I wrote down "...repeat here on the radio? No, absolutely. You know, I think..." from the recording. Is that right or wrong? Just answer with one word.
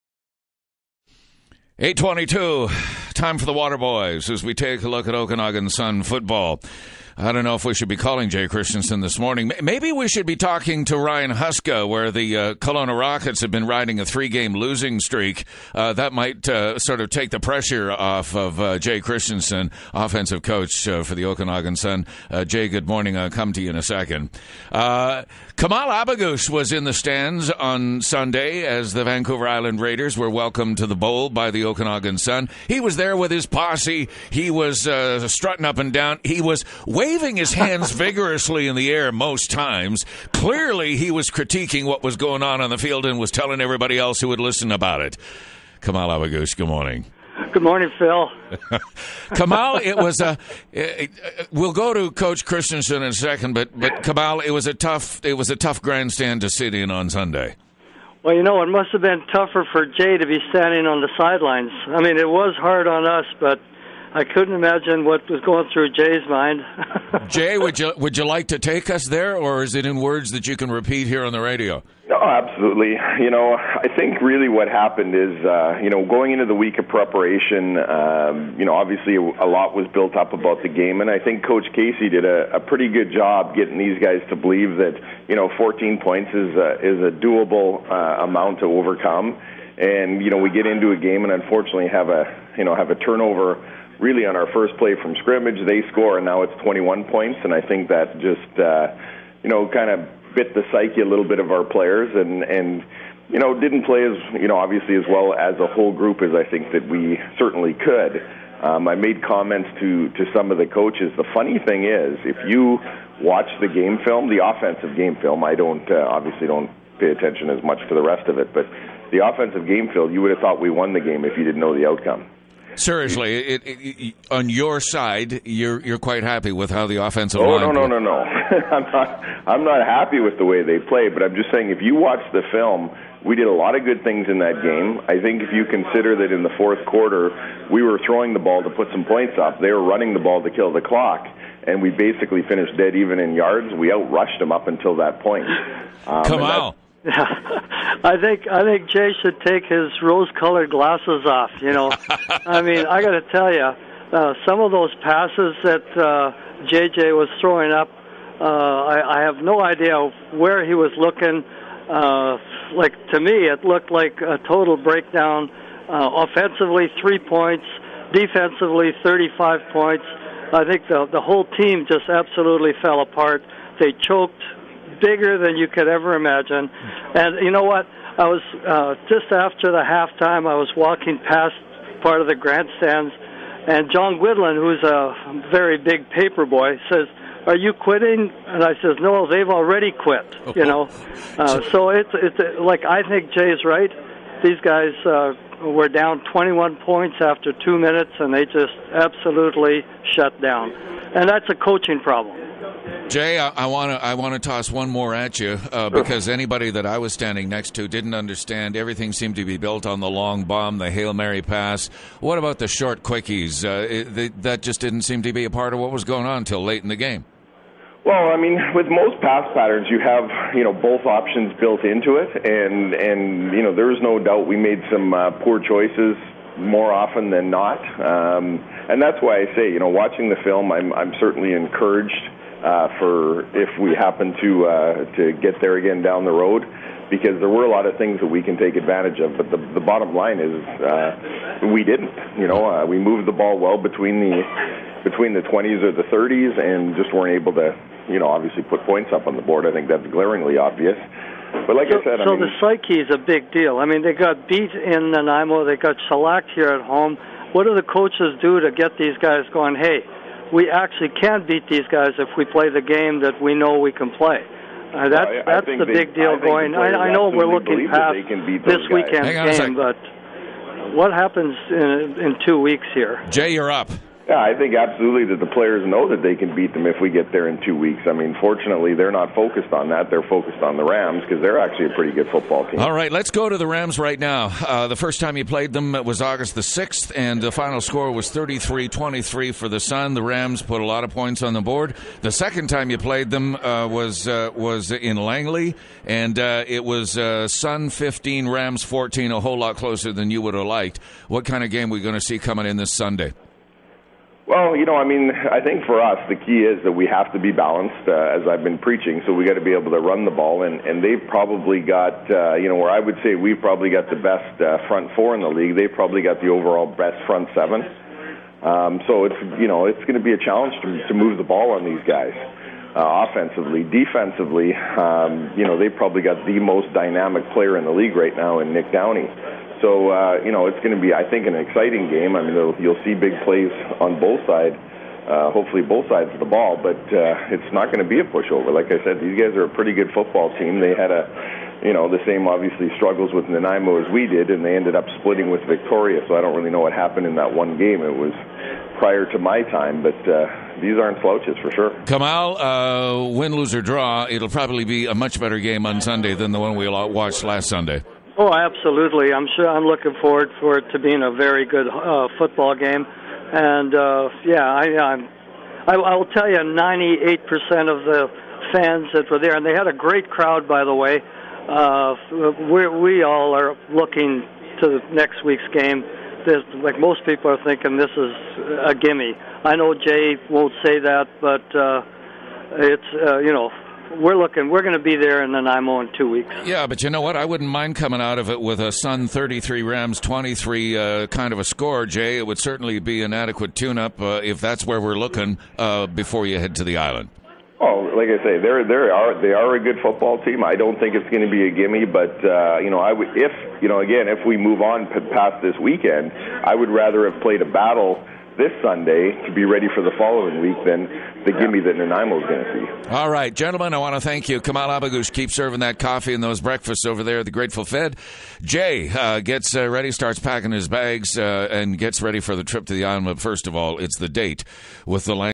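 right.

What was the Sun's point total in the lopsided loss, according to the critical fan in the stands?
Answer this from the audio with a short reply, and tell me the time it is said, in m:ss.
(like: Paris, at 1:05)
3, at 2:47.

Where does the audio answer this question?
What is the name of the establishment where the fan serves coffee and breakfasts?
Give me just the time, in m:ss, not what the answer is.
6:57.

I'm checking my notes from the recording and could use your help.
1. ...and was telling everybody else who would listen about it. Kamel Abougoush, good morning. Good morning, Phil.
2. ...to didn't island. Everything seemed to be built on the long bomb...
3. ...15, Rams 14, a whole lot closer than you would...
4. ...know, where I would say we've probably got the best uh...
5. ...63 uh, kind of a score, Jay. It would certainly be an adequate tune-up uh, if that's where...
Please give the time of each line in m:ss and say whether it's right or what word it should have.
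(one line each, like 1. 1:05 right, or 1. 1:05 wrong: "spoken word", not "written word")
1. 0:43 right
2. 3:27 wrong: "understand", not "island"
3. 4:57 right
4. 5:12 right
5. 6:30 wrong: "23", not "63".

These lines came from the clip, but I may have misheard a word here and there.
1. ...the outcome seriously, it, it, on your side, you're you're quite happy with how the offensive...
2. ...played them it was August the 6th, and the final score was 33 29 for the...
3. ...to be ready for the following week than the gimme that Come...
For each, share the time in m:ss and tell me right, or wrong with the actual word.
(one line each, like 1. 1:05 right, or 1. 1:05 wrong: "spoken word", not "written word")
1. 2:01 right
2. 4:45 wrong: "23", not "29"
3. 6:49 wrong: "Nanaimo", not "Come".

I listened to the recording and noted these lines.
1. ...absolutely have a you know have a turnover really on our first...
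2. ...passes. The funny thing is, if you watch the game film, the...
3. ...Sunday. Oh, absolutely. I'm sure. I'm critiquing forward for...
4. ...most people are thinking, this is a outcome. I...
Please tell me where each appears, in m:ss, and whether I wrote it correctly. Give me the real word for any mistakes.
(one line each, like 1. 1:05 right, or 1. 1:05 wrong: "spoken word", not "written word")
1. 1:31 wrong: "unfortunately", not "absolutely"
2. 1:50 wrong: "coaches", not "passes"
3. 5:57 wrong: "looking", not "critiquing"
4. 6:16 wrong: "gimme", not "outcome".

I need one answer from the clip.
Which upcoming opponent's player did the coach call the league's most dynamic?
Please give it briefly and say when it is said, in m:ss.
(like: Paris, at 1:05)
Nick Downey, at 5:28.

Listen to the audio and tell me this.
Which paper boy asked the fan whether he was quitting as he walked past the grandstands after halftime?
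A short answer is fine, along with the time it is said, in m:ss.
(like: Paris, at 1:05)
John Whitland, at 3:03.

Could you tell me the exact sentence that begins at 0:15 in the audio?
Uh, that might uh, sort of take the pressure off of uh, Jay Christensen, offensive coach uh, for the Okanagan Sun.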